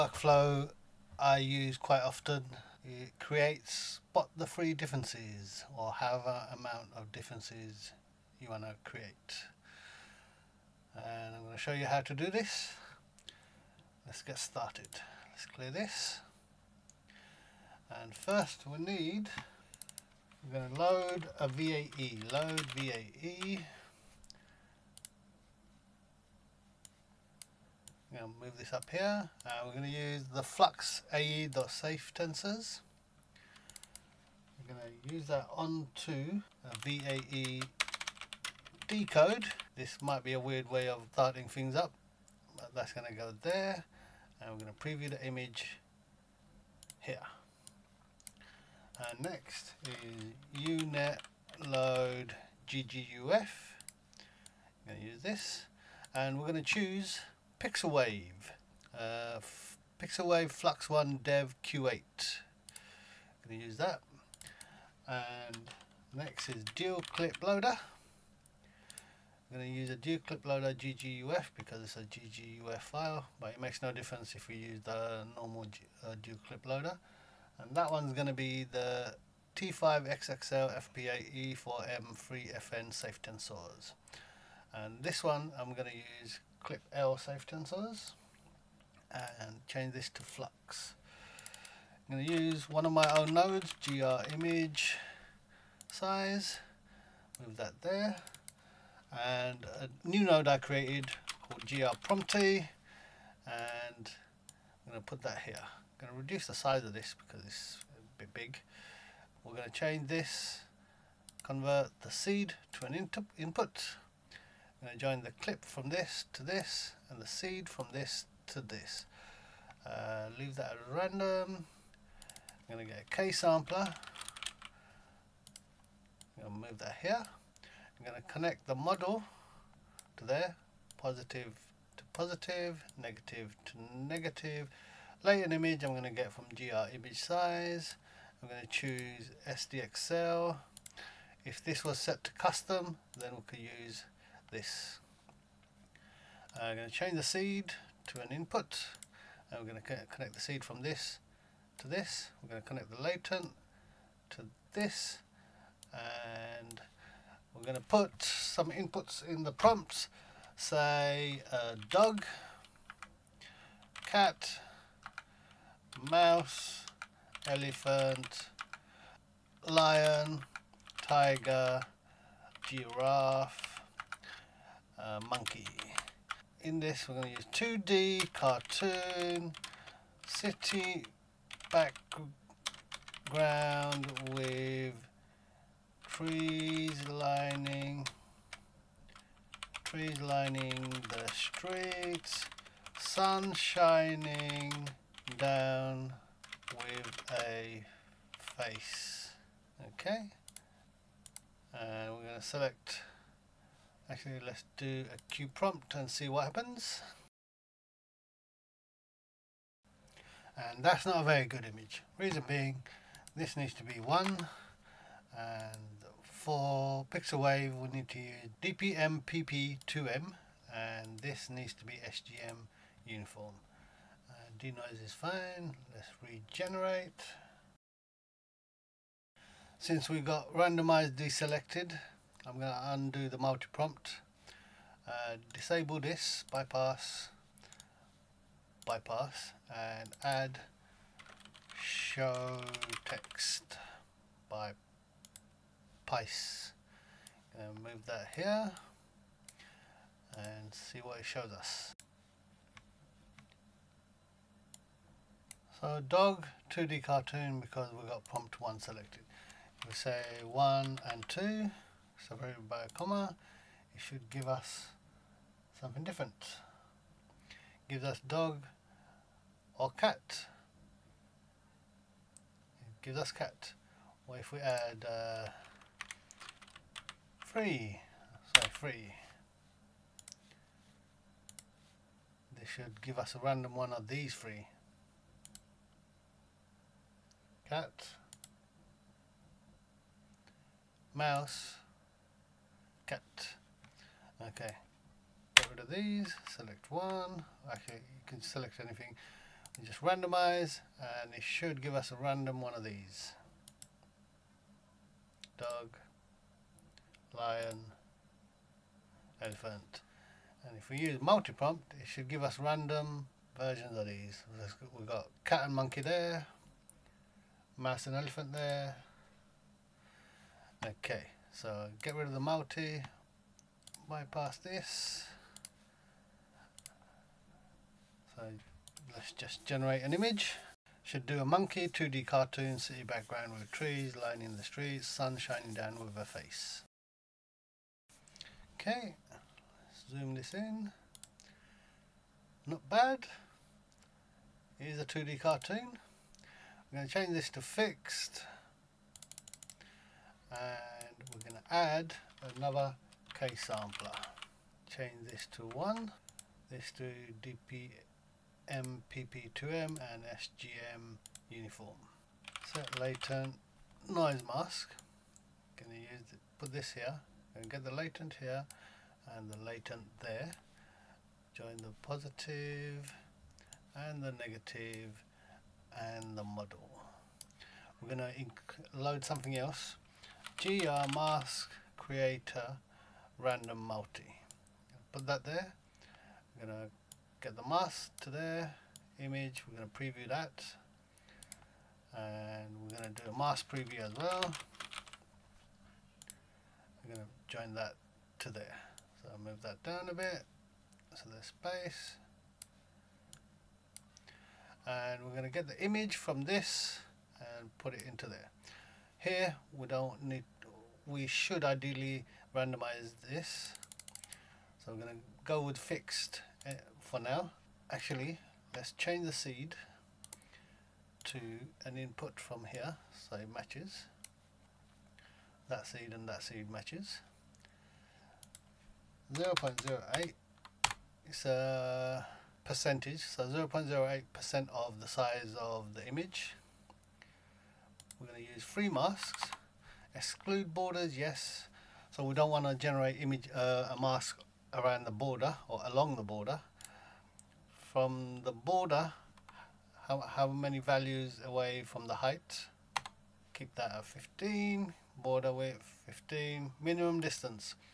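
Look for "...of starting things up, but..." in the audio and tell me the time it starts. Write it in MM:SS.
00:40.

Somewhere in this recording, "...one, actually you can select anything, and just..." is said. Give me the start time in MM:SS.
04:56.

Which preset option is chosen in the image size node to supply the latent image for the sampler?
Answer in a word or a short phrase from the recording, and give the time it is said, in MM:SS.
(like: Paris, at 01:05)
SDXL, at 02:19.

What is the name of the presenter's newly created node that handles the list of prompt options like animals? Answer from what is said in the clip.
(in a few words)
GR prompty.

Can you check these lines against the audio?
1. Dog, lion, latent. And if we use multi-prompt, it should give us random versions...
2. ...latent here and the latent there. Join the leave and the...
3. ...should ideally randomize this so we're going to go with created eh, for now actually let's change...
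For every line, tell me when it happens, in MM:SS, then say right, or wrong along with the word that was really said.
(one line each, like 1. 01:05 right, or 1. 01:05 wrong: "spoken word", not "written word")
1. 05:05 wrong: "elephant", not "latent"
2. 06:07 wrong: "positive", not "leave"
3. 06:51 wrong: "fixed", not "created".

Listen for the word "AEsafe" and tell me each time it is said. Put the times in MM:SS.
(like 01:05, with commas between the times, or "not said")
00:31.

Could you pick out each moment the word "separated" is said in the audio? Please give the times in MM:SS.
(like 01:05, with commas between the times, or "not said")
04:22.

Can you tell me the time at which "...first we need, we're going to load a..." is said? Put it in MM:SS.
00:18.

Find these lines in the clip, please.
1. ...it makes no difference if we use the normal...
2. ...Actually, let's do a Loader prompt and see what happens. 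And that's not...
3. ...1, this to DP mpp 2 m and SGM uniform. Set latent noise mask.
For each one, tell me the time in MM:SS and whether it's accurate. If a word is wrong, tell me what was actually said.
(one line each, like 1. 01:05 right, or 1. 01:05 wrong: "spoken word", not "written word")
1. 01:13 right
2. 03:24 wrong: "Queue", not "Loader"
3. 05:55 right.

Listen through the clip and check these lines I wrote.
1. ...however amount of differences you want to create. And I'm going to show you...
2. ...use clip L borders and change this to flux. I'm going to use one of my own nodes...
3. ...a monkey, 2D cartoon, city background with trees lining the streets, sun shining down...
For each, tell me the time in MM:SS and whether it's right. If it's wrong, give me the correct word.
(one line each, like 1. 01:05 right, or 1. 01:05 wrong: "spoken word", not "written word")
1. 00:05 right
2. 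01:26 wrong: "safetensors", not "borders"
3. 05:31 right.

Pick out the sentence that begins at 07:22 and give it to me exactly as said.
So we don't want to generate image uh, a mask around the border or along the border.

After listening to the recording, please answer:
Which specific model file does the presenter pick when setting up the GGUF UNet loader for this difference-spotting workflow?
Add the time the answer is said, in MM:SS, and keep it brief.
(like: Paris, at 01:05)
Pixelwave Flux One Dev Q8, at 01:00.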